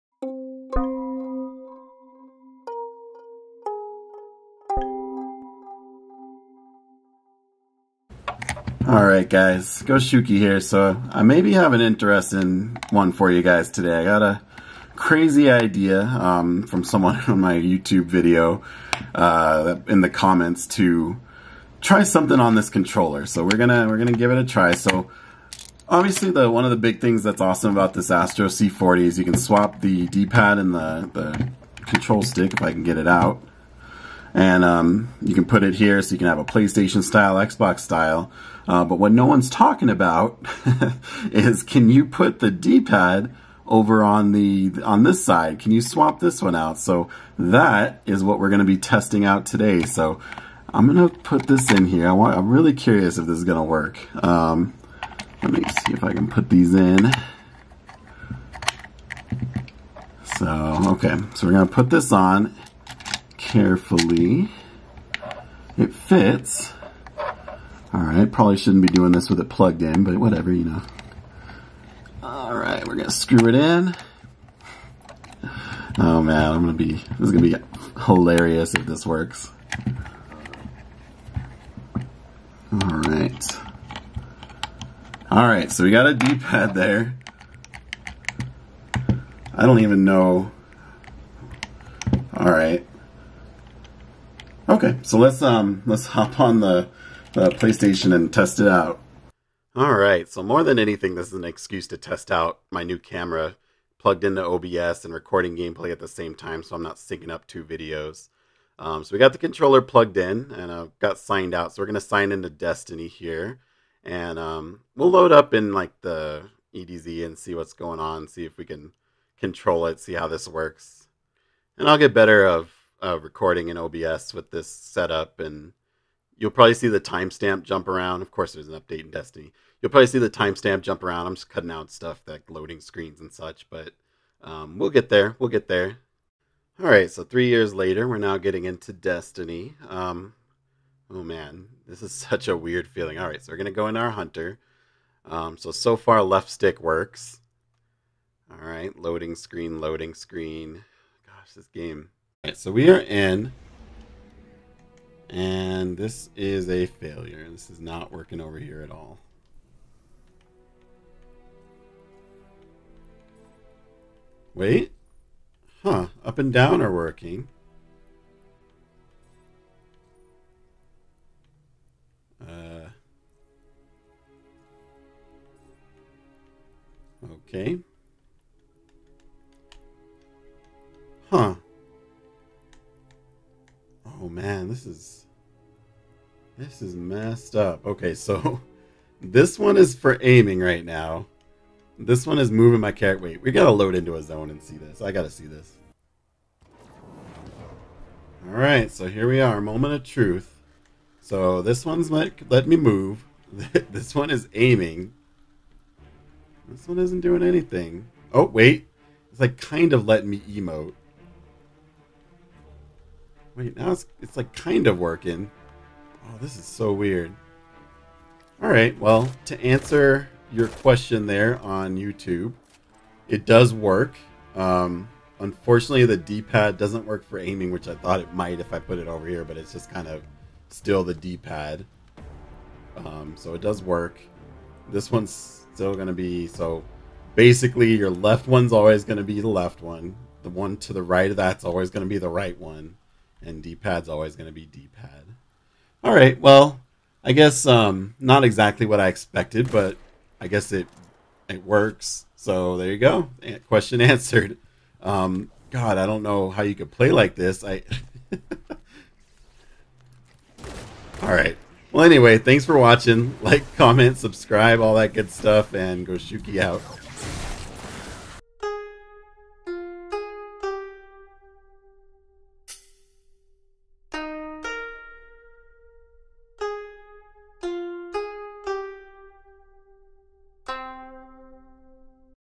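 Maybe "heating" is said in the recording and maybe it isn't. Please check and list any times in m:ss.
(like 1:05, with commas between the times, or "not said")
not said.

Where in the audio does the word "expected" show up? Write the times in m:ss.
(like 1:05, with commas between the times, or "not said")
4:09.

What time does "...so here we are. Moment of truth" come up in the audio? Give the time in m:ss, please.
3:18.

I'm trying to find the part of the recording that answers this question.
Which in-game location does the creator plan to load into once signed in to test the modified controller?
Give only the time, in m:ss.
1:56.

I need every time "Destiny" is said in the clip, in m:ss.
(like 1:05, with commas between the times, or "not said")
1:52, 2:09, 2:18.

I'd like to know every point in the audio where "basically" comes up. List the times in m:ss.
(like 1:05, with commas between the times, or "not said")
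3:57.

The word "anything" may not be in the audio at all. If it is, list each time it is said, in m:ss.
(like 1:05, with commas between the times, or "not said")
1:40, 3:27.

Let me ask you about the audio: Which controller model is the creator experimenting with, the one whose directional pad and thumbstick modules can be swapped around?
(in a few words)
Astro C40.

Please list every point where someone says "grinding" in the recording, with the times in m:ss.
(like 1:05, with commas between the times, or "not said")
not said.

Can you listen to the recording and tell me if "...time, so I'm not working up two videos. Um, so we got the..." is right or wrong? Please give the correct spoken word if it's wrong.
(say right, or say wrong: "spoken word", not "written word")
wrong: "syncing", not "working".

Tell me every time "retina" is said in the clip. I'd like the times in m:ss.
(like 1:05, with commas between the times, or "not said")
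not said.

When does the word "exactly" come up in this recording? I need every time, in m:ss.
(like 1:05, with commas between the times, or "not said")
4:08.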